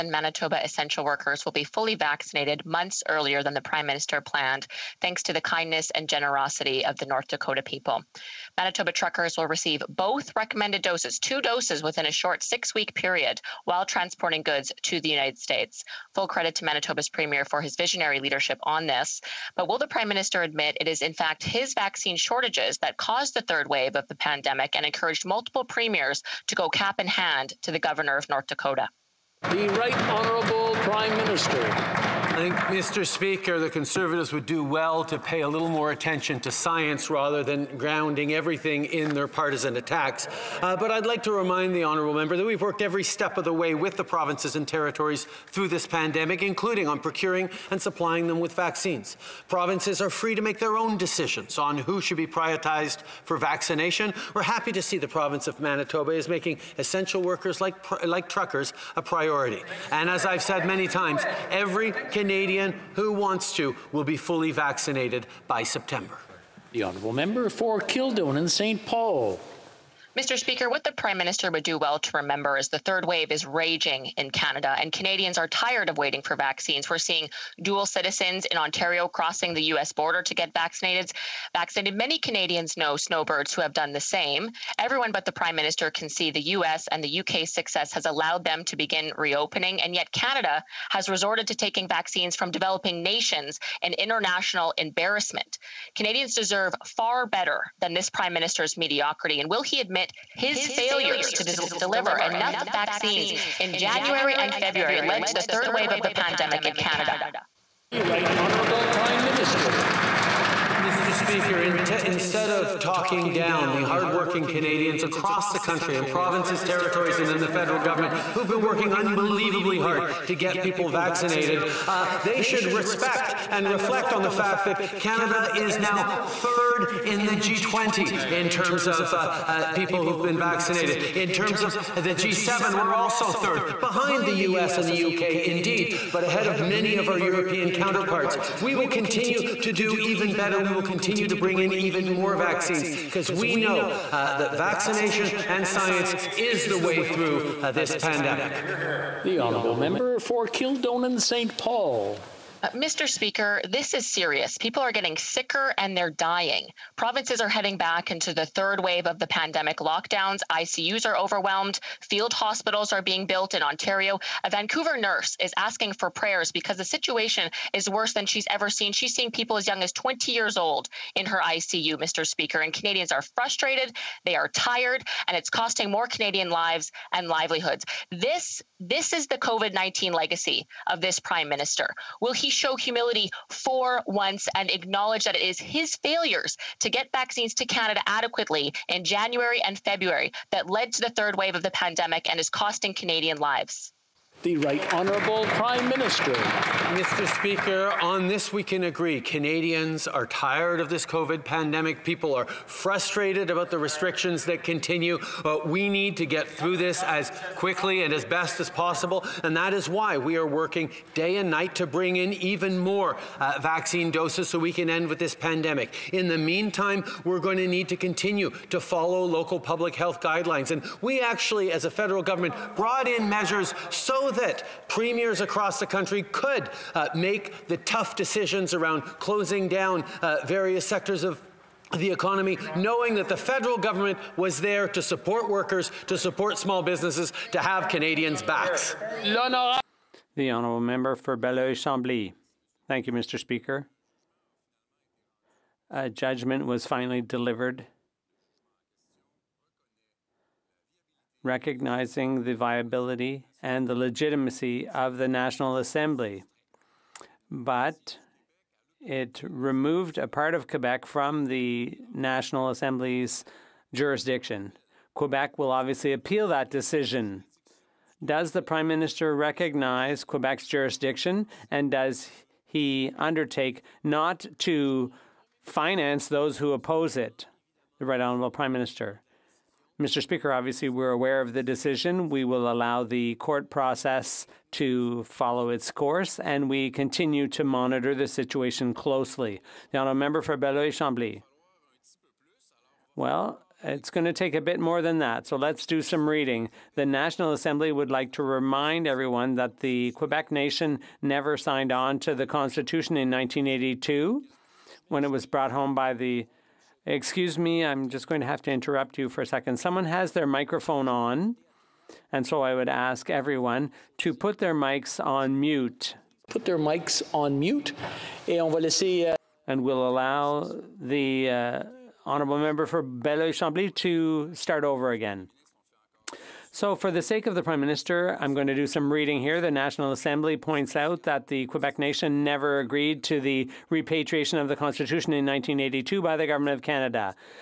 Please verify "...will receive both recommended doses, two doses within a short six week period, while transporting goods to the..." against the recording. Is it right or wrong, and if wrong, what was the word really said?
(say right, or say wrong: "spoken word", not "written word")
right.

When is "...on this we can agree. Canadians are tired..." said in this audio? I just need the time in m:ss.
3:17.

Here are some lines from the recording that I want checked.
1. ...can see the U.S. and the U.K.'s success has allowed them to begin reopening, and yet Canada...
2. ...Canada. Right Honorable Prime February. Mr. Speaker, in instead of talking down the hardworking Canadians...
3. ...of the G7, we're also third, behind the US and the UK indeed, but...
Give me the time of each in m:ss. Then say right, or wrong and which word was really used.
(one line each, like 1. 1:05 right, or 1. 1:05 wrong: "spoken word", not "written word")
1. 1:25 right
2. 1:46 wrong: "Minister", not "February"
3. 2:11 right.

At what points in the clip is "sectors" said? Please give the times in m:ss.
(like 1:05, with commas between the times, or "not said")
3:50.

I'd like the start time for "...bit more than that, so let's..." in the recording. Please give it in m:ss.
4:54.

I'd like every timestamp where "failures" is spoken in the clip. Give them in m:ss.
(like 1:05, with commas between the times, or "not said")
1:40, 3:05.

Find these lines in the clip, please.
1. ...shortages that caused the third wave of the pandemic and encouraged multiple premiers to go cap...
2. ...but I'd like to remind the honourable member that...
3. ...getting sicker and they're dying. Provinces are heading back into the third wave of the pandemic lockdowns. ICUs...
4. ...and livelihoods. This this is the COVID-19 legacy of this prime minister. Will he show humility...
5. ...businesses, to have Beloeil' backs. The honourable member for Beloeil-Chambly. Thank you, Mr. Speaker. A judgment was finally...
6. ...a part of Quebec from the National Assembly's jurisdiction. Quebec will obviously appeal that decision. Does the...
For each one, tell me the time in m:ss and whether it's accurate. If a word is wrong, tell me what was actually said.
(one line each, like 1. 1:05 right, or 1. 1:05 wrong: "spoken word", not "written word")
1. 0:22 right
2. 0:40 right
3. 2:34 right
4. 2:57 right
5. 3:56 wrong: "Canadians", not "Beloeil"
6. 4:20 right.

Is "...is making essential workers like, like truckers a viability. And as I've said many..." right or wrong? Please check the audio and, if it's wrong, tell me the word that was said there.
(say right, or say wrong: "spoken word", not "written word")
wrong: "priority", not "viability".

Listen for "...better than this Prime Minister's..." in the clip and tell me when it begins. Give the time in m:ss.
1:37.